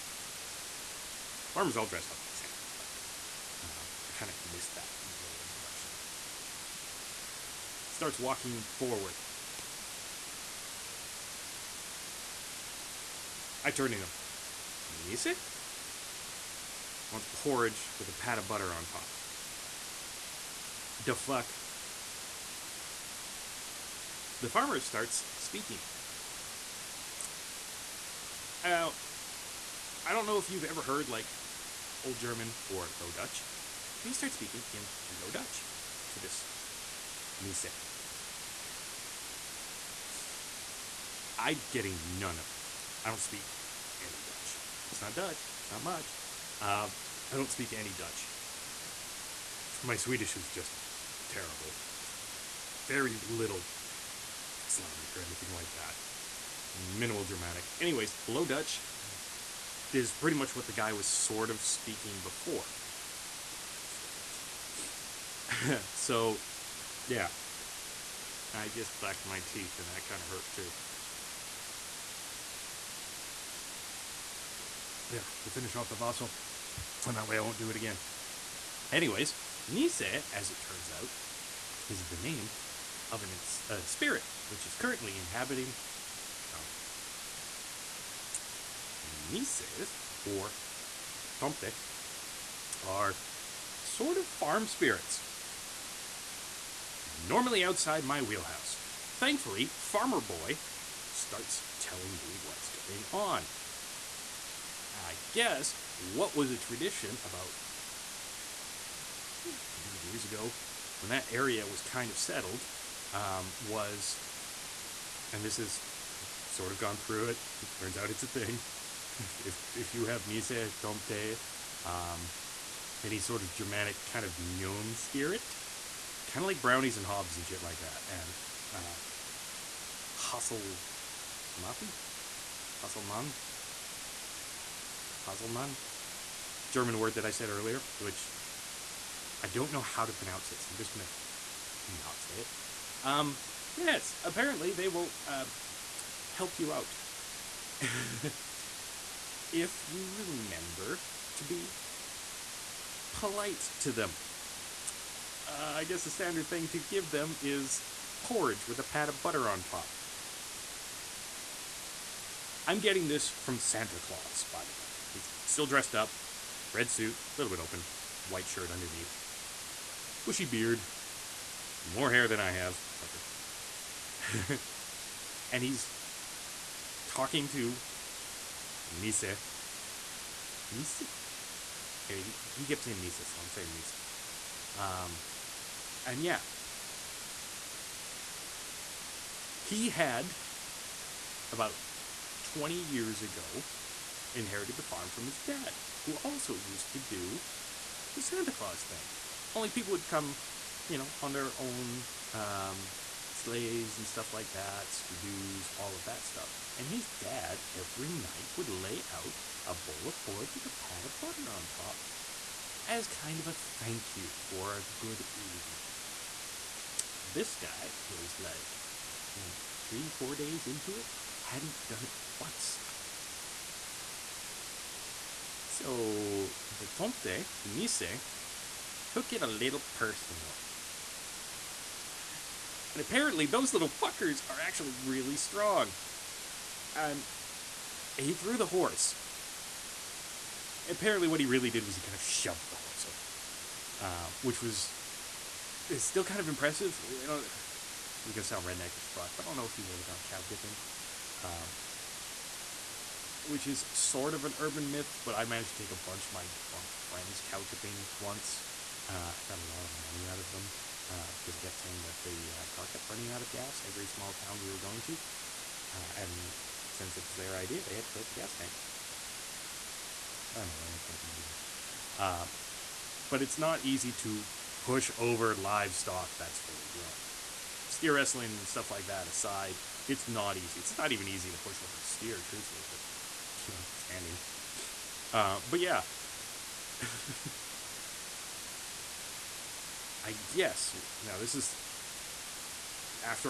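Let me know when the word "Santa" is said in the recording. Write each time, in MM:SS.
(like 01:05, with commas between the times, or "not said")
00:02, 02:43, 03:18.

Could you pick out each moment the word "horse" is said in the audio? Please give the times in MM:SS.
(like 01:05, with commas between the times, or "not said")
03:58, 04:02.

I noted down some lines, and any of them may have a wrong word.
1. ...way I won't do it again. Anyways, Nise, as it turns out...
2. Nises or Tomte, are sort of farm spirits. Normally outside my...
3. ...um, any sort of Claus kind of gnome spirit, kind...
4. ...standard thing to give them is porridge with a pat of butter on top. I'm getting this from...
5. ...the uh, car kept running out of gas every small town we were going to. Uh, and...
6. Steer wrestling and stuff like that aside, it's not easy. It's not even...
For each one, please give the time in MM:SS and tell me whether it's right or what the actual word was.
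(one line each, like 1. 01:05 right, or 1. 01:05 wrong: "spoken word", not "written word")
1. 01:17 right
2. 01:29 right
3. 02:01 wrong: "Germanic", not "Claus"
4. 02:36 right
5. 04:22 right
6. 04:37 right.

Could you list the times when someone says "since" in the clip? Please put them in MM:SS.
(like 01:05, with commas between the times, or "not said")
04:26.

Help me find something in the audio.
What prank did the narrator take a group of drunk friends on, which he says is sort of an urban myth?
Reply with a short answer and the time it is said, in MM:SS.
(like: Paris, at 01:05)
Cow tipping, at 04:17.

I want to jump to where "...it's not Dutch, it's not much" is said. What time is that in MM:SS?
00:44.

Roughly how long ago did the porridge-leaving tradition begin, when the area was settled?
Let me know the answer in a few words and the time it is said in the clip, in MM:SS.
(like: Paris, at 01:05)
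100 years ago, at 01:49.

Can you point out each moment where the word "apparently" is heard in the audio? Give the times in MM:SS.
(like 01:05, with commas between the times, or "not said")
02:24, 03:53, 04:00.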